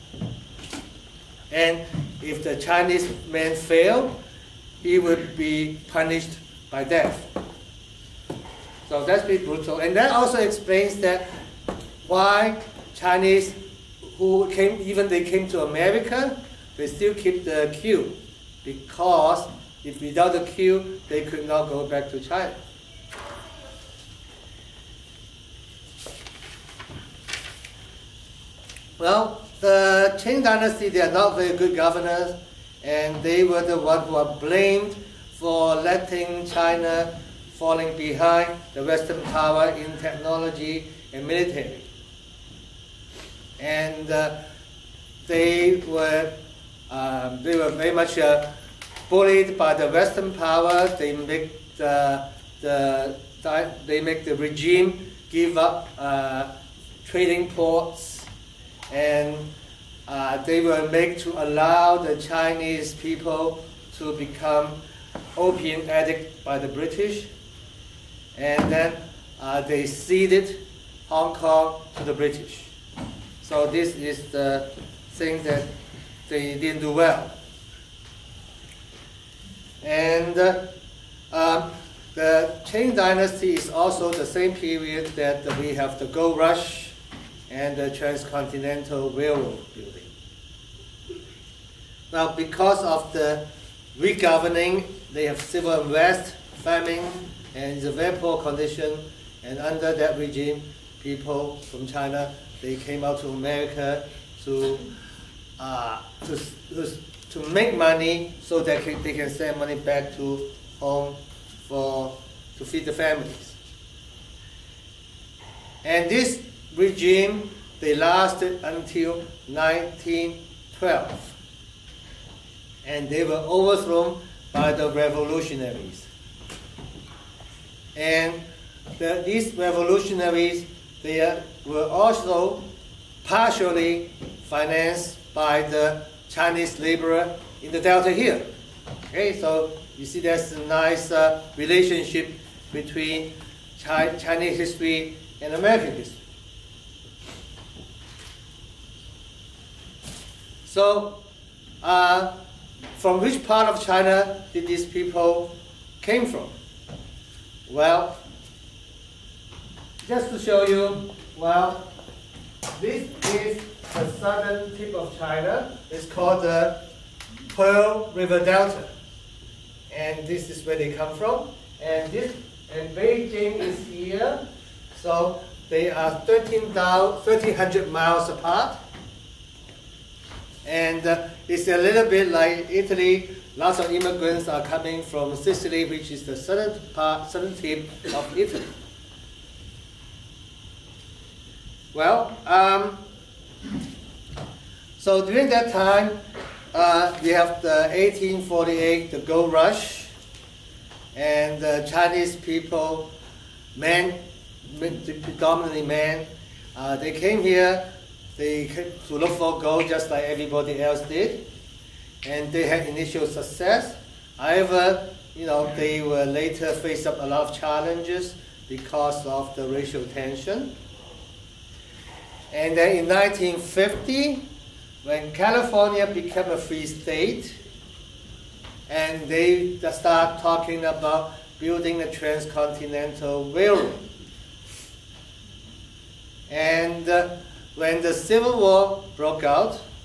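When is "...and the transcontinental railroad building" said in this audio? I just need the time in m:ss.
1:27.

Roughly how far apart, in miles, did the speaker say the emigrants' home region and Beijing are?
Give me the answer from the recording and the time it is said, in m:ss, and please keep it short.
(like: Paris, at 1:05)
1,300 miles, at 2:56.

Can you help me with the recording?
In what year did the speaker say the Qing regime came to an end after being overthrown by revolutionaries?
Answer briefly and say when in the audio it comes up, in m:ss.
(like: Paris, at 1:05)
1912, at 1:59.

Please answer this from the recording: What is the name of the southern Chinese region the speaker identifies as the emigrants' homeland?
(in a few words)
Pearl River Delta.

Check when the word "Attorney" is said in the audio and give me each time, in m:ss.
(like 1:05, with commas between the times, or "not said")
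not said.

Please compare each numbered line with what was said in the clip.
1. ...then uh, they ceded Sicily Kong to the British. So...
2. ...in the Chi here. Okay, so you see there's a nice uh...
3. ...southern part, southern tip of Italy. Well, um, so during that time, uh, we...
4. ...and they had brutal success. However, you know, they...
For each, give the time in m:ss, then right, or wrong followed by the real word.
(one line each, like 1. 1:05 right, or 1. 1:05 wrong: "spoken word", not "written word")
1. 1:08 wrong: "Hong", not "Sicily"
2. 2:17 wrong: "Delta", not "Chi"
3. 3:06 right
4. 3:32 wrong: "initial", not "brutal".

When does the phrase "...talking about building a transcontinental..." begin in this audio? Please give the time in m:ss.
3:50.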